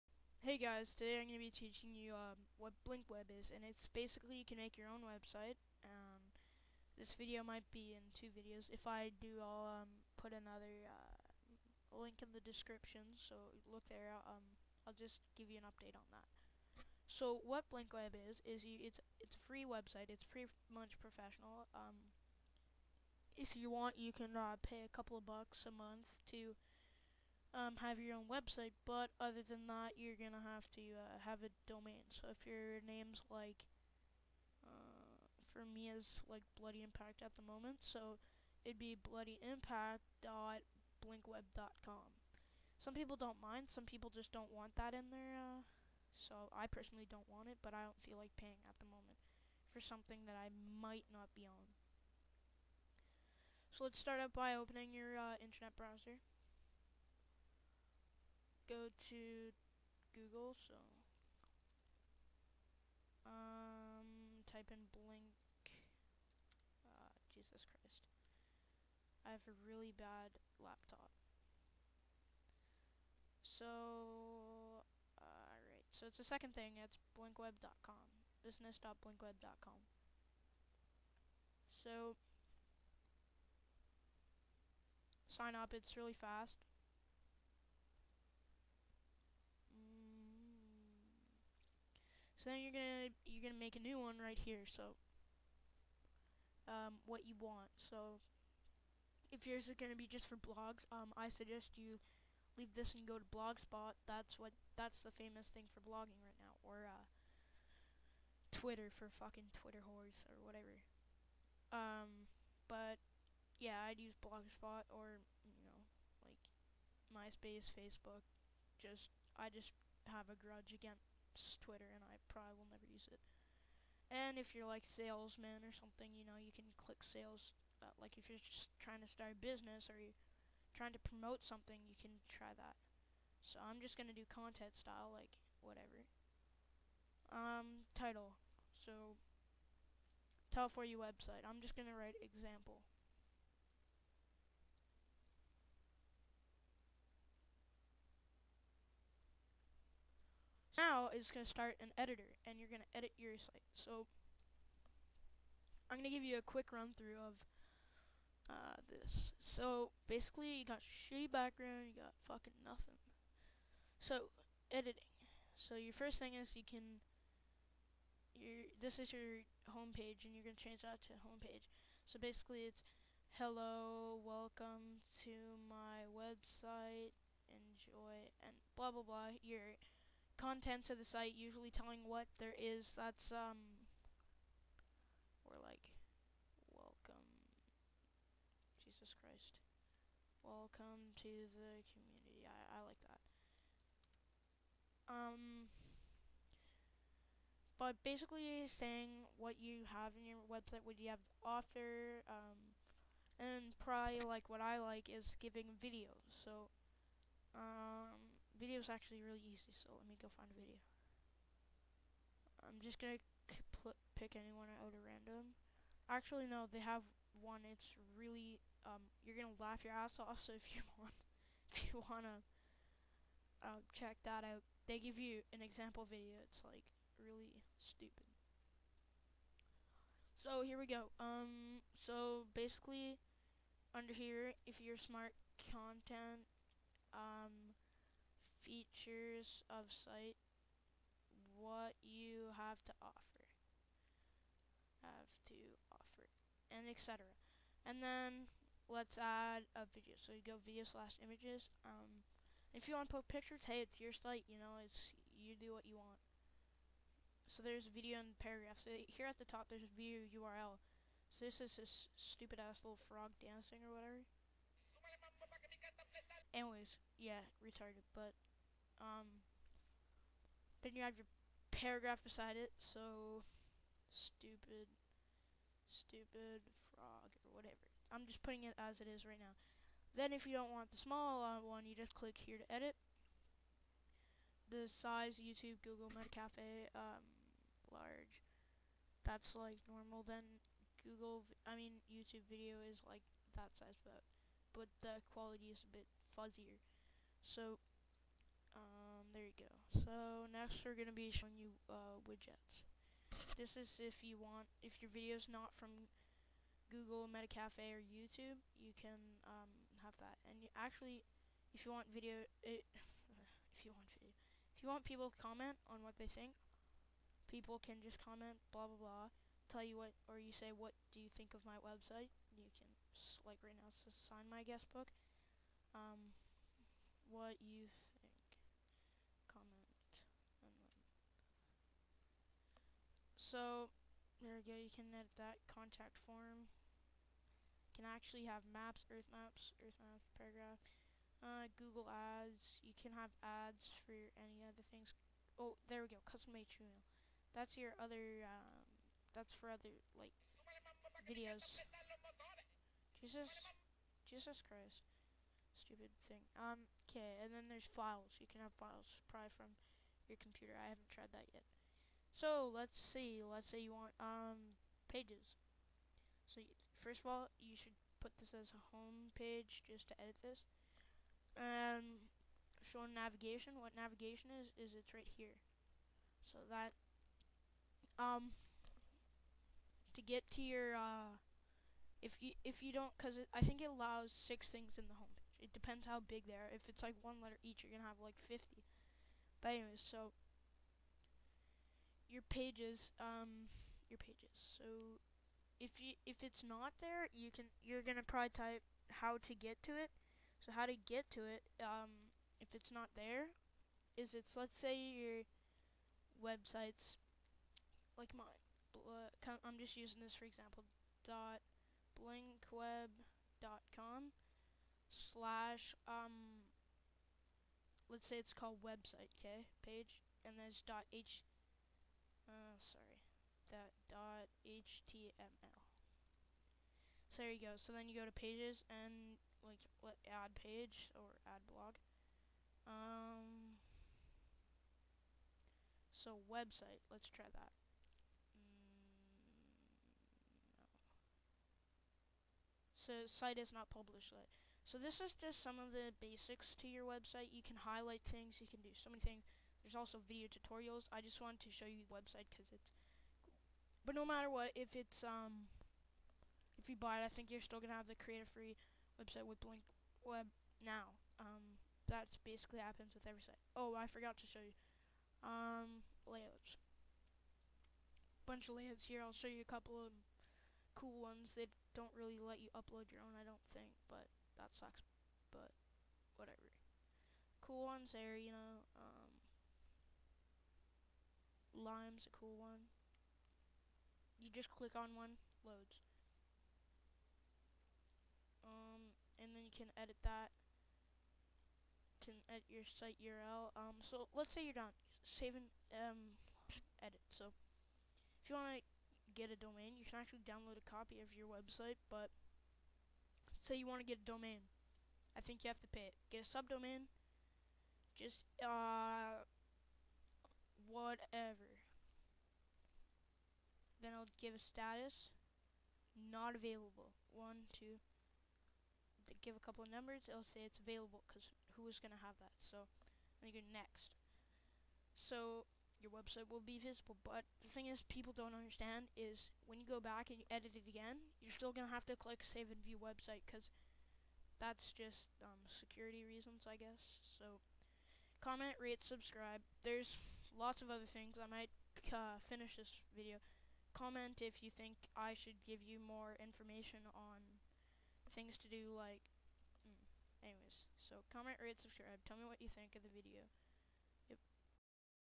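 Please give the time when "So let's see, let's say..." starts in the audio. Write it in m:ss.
6:02.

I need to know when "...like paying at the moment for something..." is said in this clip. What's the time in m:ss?
0:48.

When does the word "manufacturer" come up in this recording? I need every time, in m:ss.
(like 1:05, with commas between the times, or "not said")
not said.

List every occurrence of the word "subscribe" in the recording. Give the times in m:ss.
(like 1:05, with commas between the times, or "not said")
8:59, 9:11.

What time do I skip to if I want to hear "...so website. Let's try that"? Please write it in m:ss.
7:16.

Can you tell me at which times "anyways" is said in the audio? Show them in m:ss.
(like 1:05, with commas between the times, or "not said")
4:26, 6:29, 9:10.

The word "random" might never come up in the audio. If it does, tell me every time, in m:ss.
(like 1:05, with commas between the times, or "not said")
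3:35.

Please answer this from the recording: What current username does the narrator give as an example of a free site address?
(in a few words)
Bloody Impact.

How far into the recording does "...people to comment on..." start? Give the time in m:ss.
5:15.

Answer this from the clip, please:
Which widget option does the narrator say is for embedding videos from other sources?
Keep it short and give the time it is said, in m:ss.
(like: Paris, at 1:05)
custom HTML, at 5:46.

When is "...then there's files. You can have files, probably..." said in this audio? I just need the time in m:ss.
5:57.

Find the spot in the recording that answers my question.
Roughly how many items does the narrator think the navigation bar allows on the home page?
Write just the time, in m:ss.
6:24.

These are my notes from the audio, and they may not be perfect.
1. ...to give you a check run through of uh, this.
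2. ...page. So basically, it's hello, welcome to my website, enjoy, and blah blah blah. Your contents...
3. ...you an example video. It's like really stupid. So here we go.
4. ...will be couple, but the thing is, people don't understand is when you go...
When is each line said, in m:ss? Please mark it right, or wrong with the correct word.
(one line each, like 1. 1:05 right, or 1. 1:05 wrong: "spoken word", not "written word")
1. 2:36 wrong: "quick", not "check"
2. 2:51 right
3. 3:45 right
4. 8:46 wrong: "visible", not "couple".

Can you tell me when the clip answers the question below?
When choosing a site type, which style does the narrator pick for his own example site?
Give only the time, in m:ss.
2:14.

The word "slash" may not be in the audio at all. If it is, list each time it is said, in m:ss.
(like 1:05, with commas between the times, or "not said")
4:10, 6:55.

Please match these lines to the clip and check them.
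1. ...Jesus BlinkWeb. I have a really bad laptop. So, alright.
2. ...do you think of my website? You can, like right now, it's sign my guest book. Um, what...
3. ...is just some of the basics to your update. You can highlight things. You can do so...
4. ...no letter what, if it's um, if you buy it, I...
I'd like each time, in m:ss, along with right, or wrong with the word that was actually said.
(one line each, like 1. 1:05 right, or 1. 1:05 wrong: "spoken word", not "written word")
1. 1:07 wrong: "Christ", not "BlinkWeb"
2. 5:21 right
3. 7:25 wrong: "website", not "update"
4. 7:34 wrong: "matter", not "letter".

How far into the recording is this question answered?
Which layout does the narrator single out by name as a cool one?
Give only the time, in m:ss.
8:01.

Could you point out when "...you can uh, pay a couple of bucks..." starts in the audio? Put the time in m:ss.
0:23.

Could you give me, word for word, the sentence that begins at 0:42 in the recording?
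Some people don't mind, some people just don't want that in there.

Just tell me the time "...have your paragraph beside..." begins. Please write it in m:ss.
4:31.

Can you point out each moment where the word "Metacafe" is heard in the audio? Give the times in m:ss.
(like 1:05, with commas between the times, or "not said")
4:46, 5:07.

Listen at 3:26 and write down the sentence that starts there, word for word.
So, um, is actually really easy, so let me go find a video.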